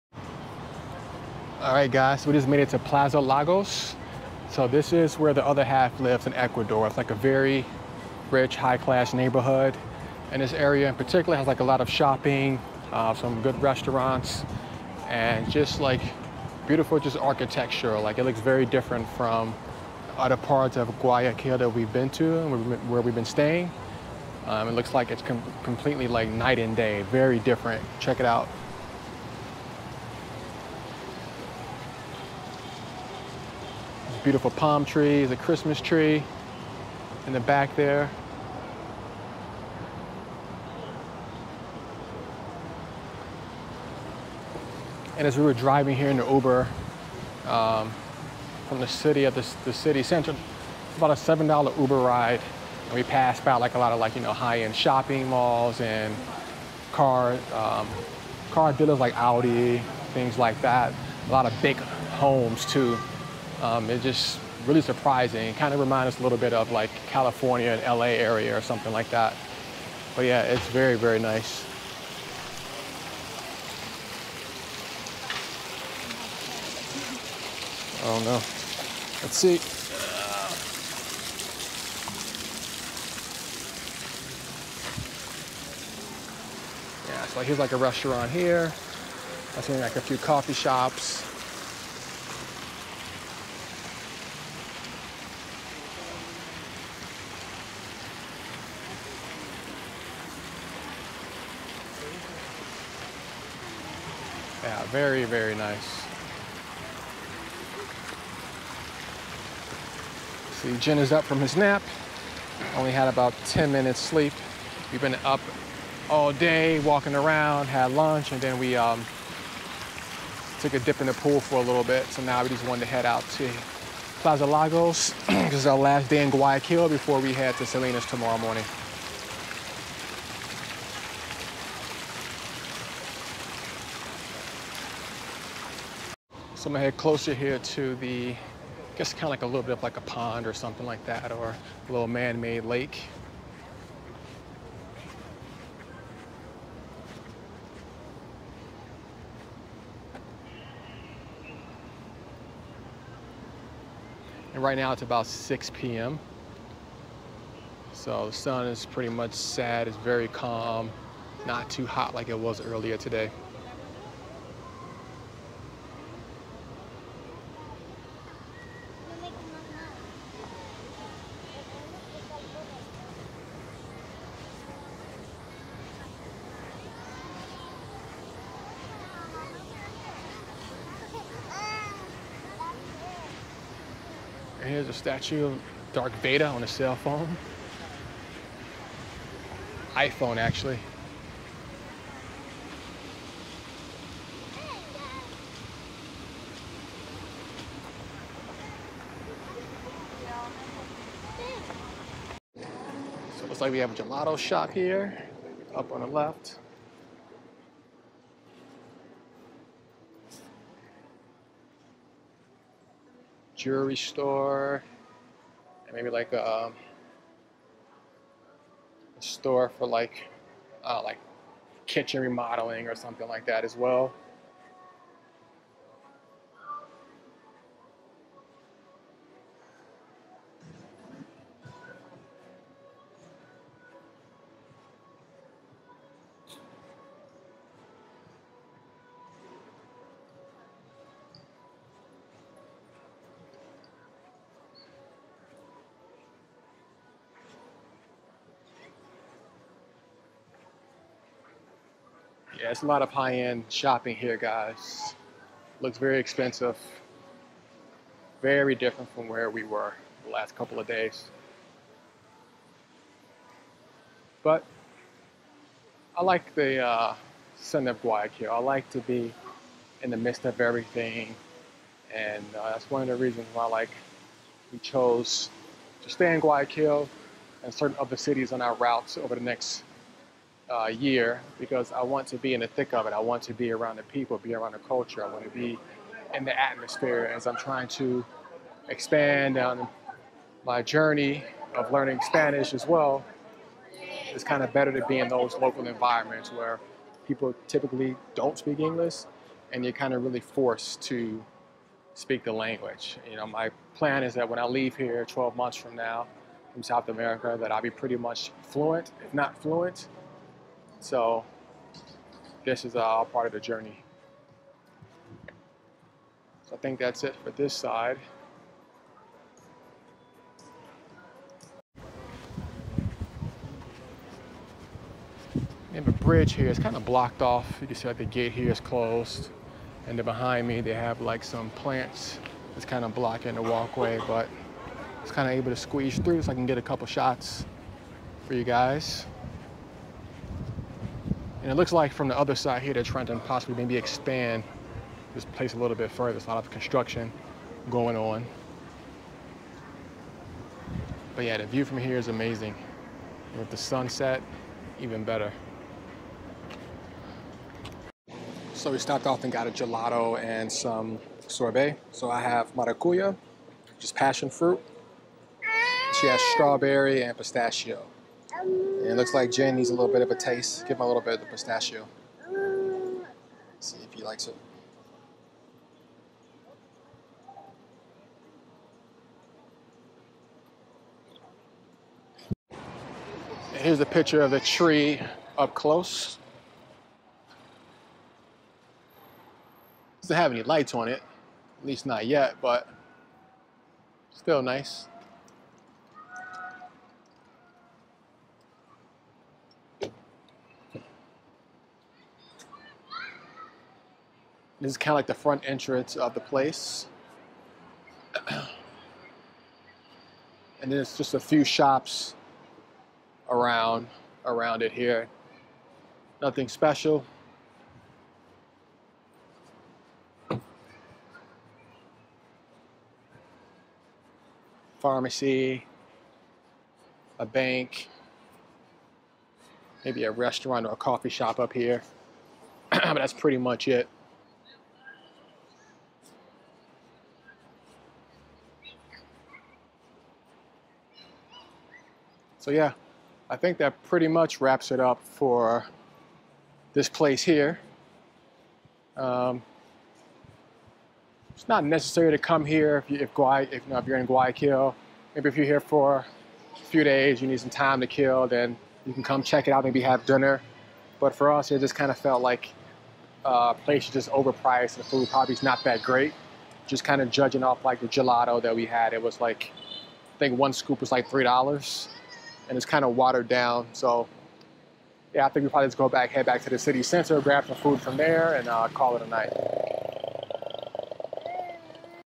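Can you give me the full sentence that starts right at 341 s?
And it looks like from the other side here, they're trying to possibly maybe expand this place a little bit further.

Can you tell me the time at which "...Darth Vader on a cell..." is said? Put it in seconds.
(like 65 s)
185 s.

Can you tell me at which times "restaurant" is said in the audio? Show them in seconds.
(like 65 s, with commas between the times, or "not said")
13 s, 87 s, 430 s.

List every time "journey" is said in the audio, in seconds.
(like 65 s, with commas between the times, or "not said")
290 s, 313 s.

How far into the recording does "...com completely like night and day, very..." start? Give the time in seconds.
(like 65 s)
25 s.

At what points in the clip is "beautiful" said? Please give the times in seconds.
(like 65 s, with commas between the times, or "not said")
16 s, 34 s.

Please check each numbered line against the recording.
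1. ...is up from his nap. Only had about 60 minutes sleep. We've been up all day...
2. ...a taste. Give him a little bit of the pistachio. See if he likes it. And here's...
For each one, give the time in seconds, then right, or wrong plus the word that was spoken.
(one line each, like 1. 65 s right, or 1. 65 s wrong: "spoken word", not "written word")
1. 110 s wrong: "10", not "60"
2. 370 s right.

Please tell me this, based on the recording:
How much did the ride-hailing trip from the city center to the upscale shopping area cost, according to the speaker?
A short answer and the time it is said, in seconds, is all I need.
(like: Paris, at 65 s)
$7, at 51 s.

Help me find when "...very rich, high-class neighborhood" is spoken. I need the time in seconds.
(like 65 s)
7 s.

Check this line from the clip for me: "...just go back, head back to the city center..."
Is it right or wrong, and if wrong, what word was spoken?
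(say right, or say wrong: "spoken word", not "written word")
right.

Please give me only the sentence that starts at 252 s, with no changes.
Yeah, it's a lot of high-end shopping here, guys.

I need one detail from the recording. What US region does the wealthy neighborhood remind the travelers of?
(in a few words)
California.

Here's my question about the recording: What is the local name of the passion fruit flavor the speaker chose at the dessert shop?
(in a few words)
maracuya.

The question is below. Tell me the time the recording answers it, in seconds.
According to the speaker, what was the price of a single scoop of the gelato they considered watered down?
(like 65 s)
471 s.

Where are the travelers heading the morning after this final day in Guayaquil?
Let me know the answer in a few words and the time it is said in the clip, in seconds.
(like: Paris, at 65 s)
Salinas, at 127 s.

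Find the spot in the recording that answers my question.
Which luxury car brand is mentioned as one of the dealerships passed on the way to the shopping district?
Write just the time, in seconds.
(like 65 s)
59 s.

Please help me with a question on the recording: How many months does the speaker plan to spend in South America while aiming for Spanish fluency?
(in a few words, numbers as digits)
12 months.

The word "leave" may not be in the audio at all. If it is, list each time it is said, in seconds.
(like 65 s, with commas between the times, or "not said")
304 s.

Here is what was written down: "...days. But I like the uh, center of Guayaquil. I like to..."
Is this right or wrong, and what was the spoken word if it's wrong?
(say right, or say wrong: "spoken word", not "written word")
right.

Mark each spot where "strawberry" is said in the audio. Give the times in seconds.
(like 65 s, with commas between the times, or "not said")
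366 s.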